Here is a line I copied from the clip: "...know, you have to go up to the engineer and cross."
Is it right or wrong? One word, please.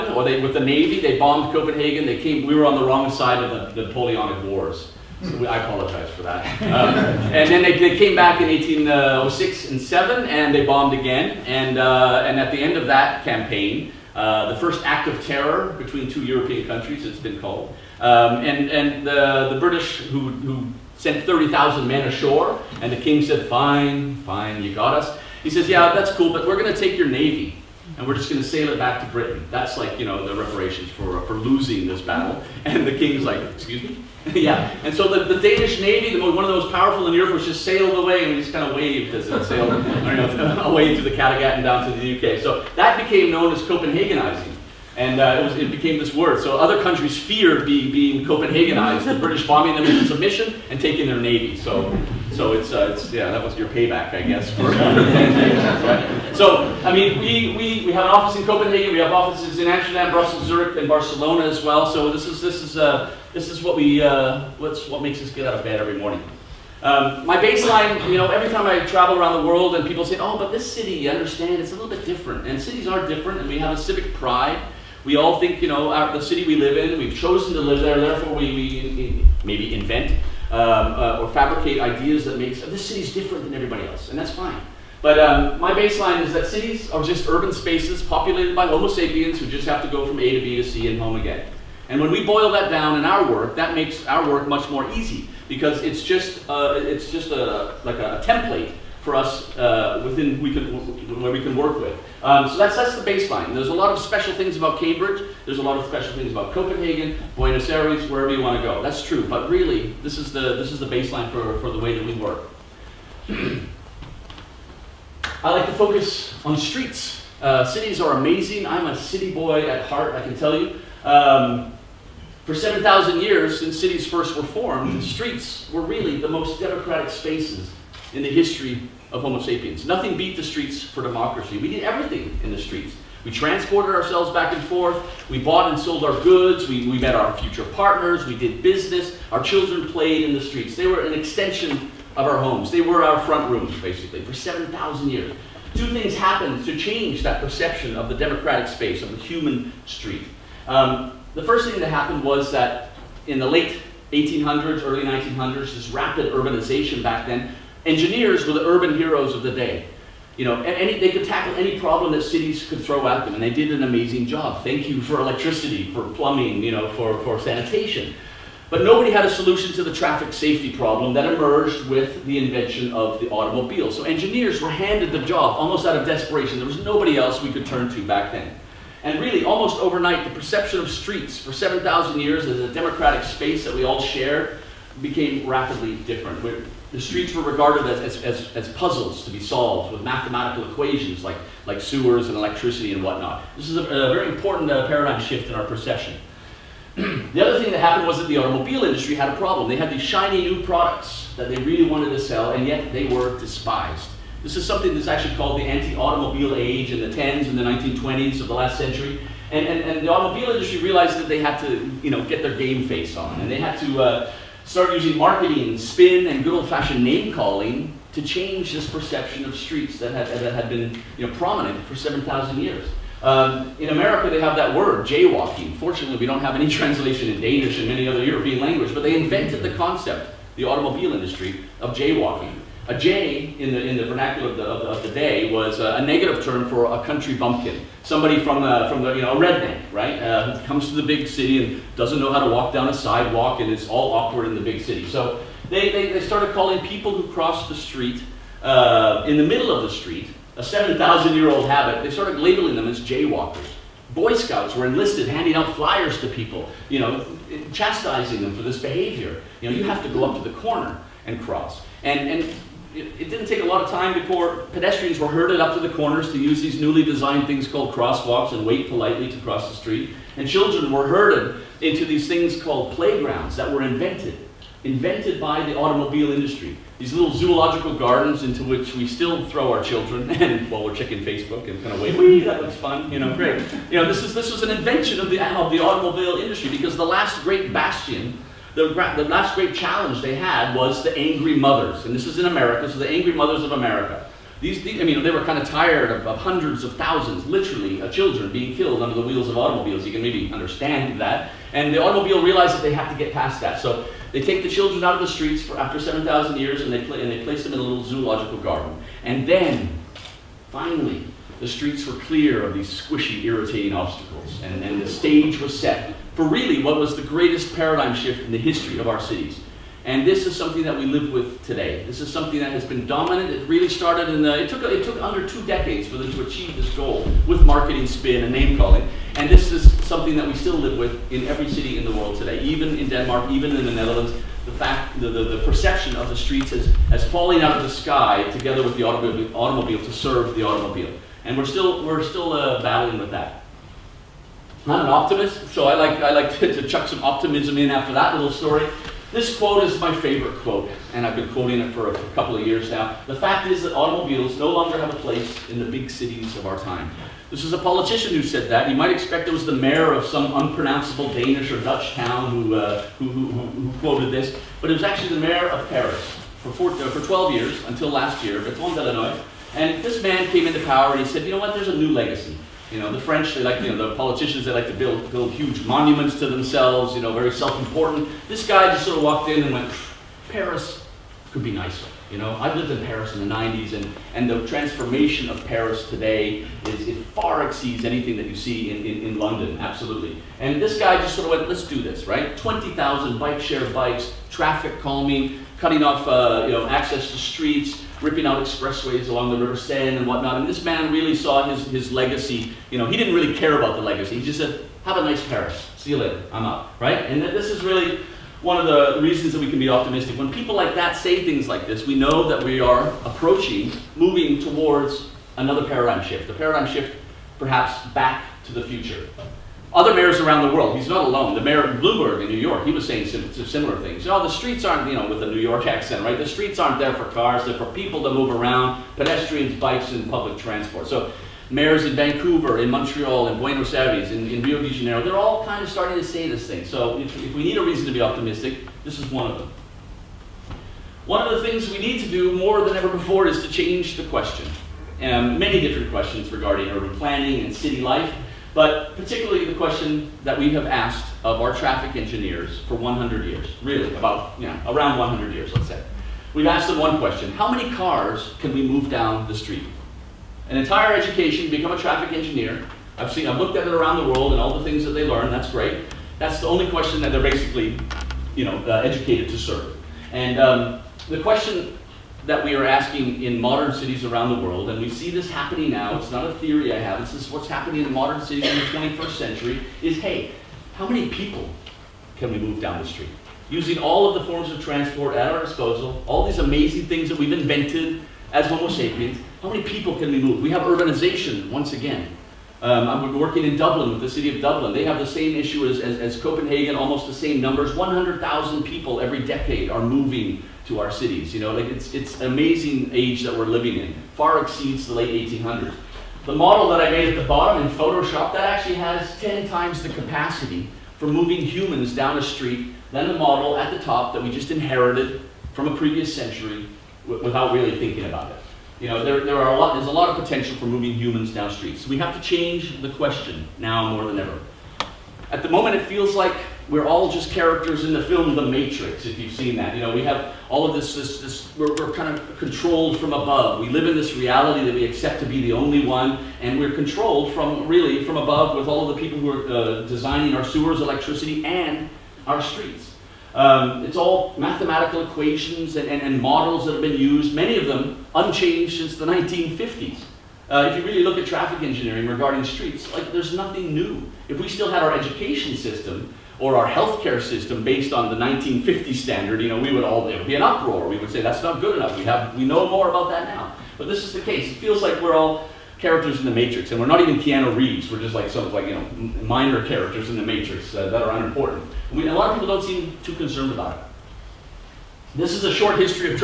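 wrong.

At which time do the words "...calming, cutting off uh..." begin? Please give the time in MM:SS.
06:35.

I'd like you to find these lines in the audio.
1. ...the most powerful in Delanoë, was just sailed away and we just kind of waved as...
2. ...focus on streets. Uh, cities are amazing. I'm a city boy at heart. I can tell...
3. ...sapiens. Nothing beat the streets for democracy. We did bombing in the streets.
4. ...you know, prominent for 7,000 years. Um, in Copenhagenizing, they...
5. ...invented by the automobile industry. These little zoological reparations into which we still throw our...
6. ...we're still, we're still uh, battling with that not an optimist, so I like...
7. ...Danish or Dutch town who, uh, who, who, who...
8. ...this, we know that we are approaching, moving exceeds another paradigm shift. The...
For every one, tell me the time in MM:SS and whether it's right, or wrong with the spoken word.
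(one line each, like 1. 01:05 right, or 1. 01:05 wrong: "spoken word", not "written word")
1. 00:36 wrong: "Europe", not "Delanoë"
2. 01:55 right
3. 02:09 wrong: "everything", not "bombing"
4. 03:41 wrong: "America", not "Copenhagenizing"
5. 04:34 wrong: "gardens", not "reparations"
6. 05:41 right
7. 06:01 right
8. 06:51 wrong: "towards", not "exceeds".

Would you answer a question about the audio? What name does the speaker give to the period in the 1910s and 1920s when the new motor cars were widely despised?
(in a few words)
anti-automobile age.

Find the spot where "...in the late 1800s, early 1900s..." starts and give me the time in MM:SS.
02:33.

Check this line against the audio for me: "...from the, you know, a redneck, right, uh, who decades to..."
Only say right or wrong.
wrong.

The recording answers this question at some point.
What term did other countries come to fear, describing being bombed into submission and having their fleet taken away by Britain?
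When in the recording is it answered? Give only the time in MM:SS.
00:43.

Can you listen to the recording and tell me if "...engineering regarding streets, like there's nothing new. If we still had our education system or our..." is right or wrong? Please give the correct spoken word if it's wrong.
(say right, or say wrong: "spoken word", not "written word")
right.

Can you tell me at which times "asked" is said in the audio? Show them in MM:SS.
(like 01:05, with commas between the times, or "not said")
07:30, 07:36.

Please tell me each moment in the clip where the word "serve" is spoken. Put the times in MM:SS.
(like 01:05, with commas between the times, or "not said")
05:40, 07:49.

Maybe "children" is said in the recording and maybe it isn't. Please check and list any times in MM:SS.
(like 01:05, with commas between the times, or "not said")
02:19, 04:30, 04:39, 04:58, 05:04.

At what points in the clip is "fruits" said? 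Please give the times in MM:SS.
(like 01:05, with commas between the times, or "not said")
not said.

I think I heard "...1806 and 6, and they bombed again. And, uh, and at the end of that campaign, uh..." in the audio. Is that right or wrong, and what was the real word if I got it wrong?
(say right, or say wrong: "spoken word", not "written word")
wrong: "7", not "6".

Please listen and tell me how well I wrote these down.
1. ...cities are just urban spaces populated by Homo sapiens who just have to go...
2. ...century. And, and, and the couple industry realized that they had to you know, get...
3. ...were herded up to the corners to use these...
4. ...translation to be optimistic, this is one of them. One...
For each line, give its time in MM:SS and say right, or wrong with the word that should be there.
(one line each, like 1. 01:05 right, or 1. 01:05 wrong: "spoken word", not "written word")
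1. 01:26 right
2. 03:28 wrong: "automobile", not "couple"
3. 04:25 right
4. 07:17 wrong: "reason", not "translation".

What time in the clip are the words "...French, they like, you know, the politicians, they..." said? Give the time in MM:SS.
06:13.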